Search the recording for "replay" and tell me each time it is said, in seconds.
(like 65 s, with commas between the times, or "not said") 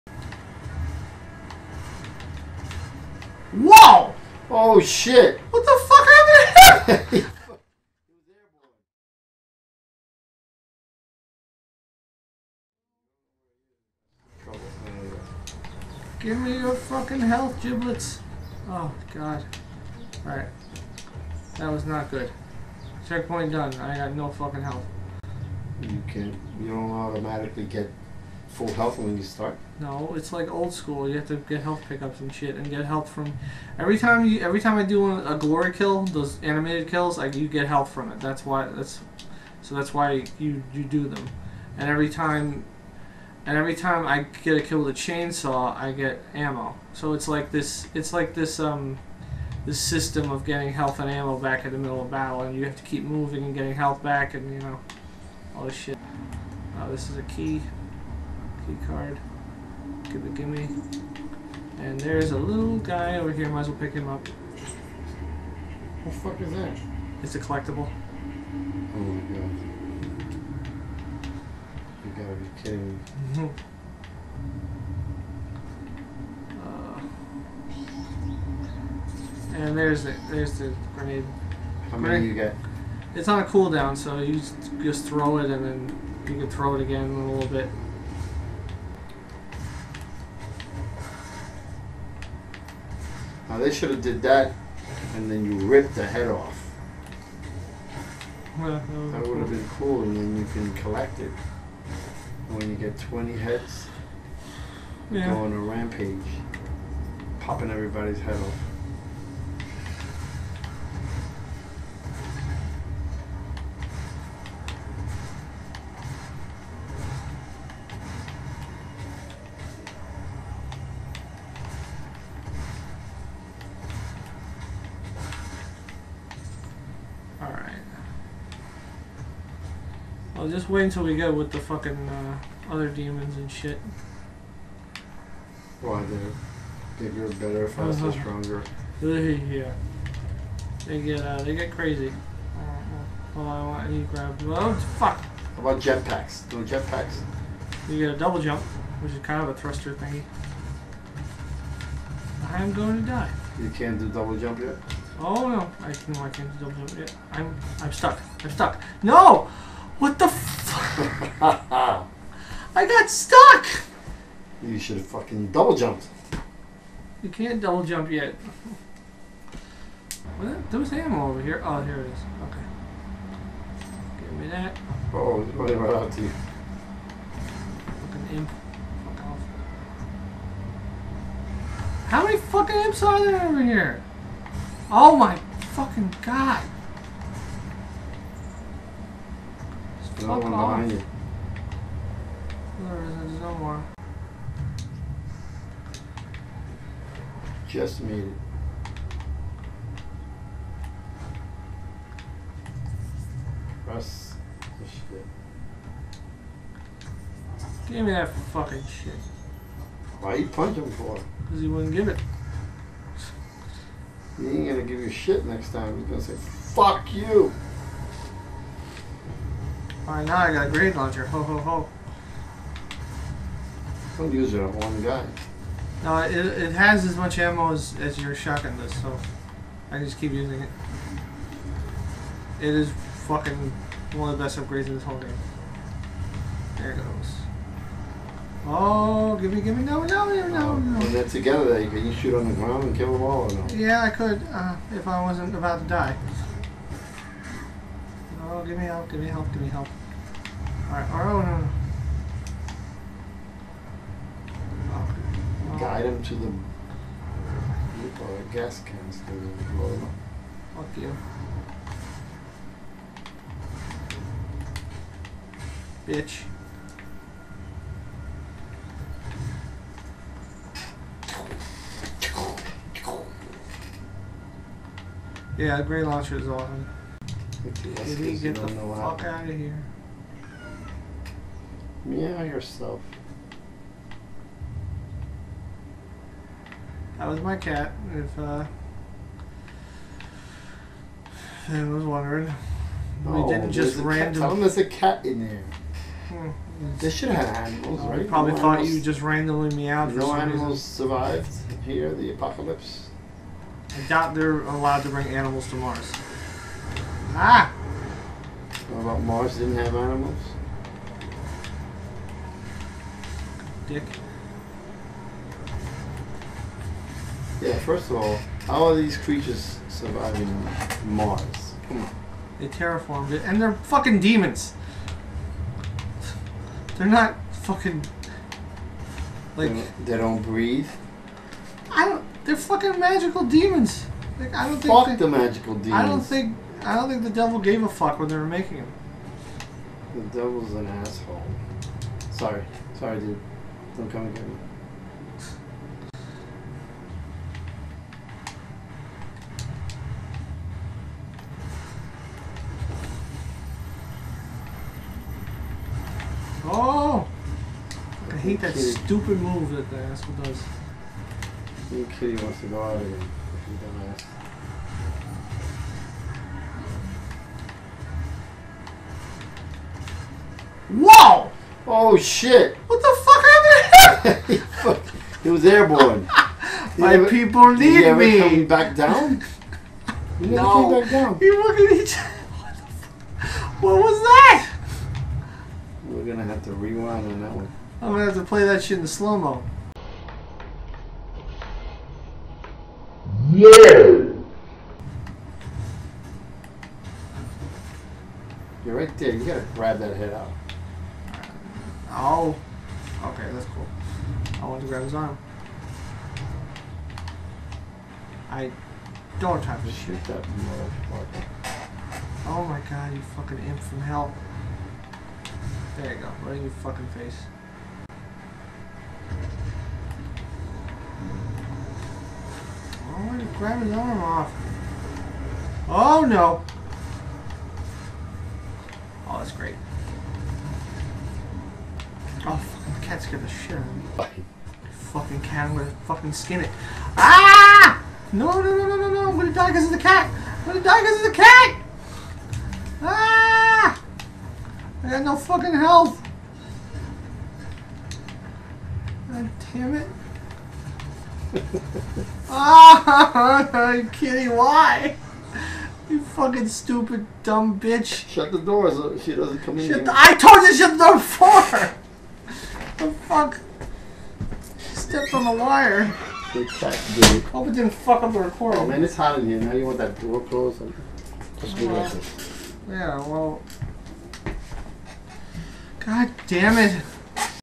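not said.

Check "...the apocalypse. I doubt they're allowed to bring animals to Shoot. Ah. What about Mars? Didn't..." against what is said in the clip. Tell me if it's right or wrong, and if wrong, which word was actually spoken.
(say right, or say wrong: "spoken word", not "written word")
wrong: "Mars", not "Shoot".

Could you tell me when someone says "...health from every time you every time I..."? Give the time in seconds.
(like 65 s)
32 s.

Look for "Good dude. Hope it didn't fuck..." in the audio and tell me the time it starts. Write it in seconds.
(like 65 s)
466 s.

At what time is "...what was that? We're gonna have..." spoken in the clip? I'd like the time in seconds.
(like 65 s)
383 s.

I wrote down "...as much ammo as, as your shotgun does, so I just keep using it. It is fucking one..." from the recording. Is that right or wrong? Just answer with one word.
right.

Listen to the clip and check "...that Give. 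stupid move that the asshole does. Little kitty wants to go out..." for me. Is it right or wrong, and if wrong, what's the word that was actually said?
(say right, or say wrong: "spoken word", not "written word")
wrong: "Kitty", not "Give".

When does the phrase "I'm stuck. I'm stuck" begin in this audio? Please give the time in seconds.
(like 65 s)
157 s.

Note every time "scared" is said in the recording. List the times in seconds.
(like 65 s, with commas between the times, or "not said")
433 s.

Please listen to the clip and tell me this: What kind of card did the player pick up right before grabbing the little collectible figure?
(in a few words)
Key recipe card.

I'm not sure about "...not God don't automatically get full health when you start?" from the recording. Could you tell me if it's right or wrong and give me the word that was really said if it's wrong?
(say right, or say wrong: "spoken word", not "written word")
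wrong: "You", not "God".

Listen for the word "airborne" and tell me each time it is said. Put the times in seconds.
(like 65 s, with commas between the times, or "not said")
375 s.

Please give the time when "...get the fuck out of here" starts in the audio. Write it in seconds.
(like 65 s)
278 s.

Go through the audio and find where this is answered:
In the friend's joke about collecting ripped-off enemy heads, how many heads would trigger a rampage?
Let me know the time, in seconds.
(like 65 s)
102 s.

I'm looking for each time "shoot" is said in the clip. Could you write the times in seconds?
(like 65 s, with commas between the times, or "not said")
242 s, 409 s.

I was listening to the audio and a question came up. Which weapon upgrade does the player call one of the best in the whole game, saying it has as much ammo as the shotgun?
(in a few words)
Grenade launcher.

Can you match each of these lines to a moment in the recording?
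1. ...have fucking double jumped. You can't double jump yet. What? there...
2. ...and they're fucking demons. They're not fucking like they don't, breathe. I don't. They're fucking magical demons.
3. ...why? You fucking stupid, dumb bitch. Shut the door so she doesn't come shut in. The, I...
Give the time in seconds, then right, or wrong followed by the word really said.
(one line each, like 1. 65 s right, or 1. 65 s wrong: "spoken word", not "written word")
1. 164 s right
2. 323 s right
3. 454 s right.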